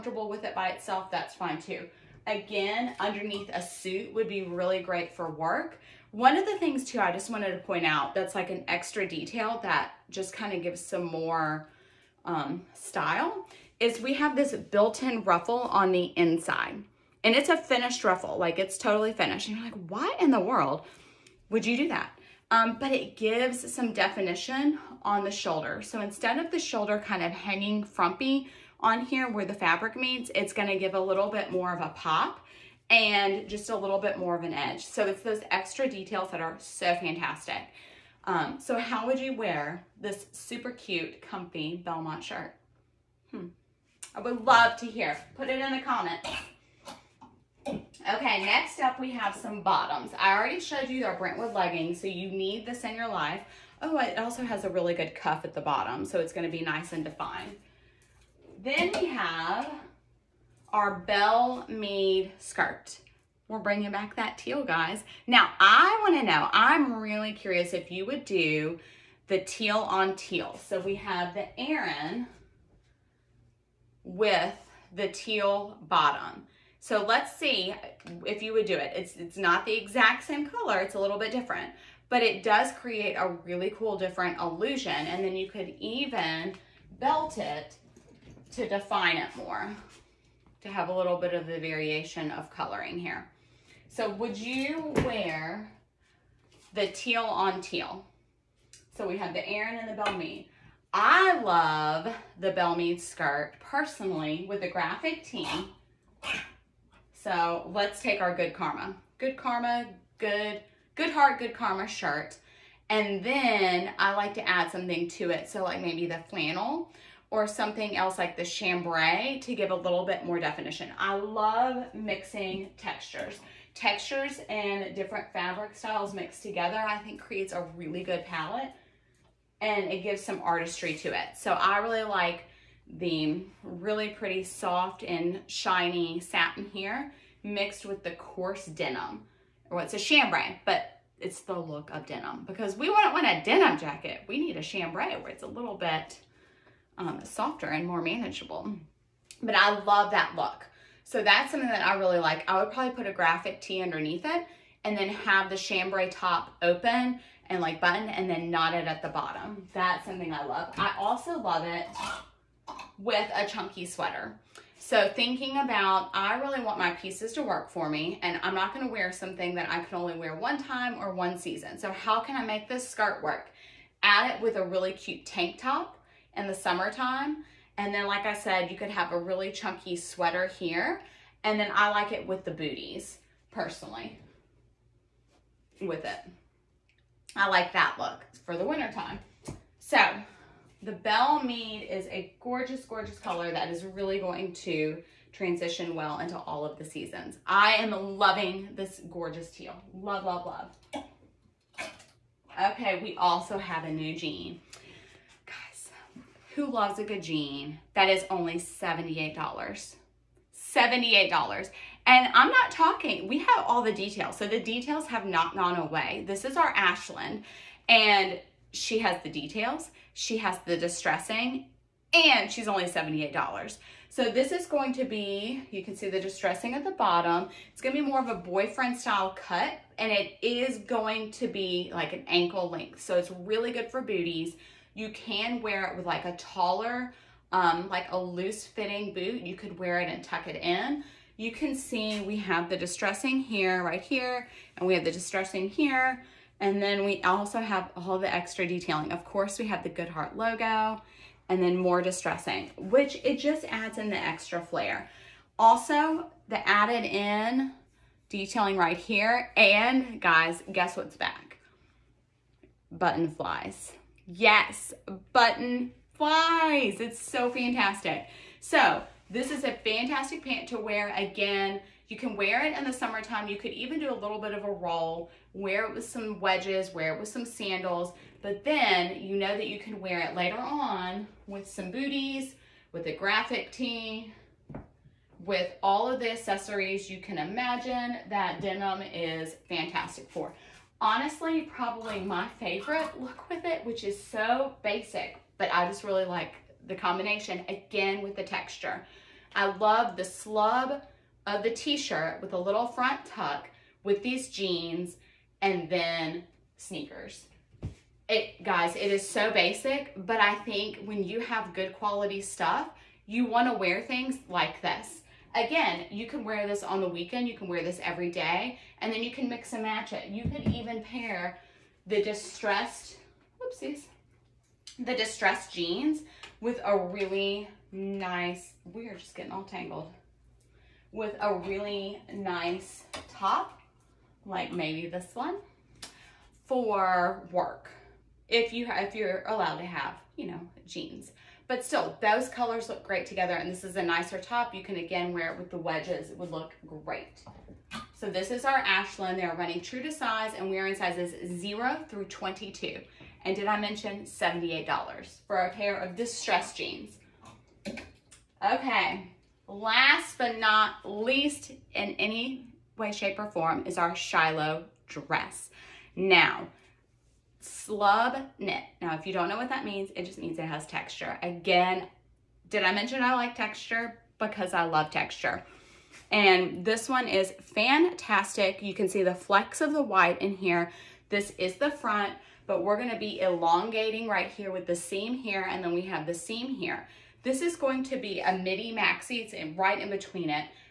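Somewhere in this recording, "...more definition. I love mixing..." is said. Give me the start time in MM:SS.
02:00.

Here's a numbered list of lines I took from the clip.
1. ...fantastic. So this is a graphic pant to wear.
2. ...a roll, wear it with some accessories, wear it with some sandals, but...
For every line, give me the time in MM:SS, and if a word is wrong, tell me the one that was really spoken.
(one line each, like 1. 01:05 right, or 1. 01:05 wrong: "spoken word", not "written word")
1. 04:27 wrong: "fantastic", not "graphic"
2. 04:34 wrong: "wedges", not "accessories".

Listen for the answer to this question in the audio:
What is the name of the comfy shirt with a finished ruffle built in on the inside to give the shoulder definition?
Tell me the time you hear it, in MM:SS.
00:41.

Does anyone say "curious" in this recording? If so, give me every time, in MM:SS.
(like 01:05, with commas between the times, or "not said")
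01:07.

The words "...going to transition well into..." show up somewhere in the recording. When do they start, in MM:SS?
03:14.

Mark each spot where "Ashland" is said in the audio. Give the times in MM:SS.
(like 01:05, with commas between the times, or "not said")
03:36, 05:48.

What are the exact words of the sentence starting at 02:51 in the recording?
So how can I make this skirt work?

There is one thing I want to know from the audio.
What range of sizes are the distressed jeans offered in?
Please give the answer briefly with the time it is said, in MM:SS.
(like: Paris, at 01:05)
0 through 22, at 05:51.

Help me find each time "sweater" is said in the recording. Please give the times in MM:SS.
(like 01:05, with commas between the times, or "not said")
02:43, 02:59.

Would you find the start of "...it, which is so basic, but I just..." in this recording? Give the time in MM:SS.
04:53.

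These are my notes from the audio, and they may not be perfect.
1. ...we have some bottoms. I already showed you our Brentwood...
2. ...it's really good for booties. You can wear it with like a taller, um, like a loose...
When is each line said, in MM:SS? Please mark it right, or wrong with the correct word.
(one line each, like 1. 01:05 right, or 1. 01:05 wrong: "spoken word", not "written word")
1. 00:48 right
2. 03:53 right.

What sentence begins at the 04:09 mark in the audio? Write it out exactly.
Of course, we have the Good Hart logo and then more distressing, which it just adds in the extra flair.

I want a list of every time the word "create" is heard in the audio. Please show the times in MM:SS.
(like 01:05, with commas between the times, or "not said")
01:22, 02:07.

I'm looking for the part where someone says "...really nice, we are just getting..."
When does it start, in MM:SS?
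05:26.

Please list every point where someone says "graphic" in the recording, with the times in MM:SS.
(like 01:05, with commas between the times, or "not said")
01:44, 02:33, 04:43.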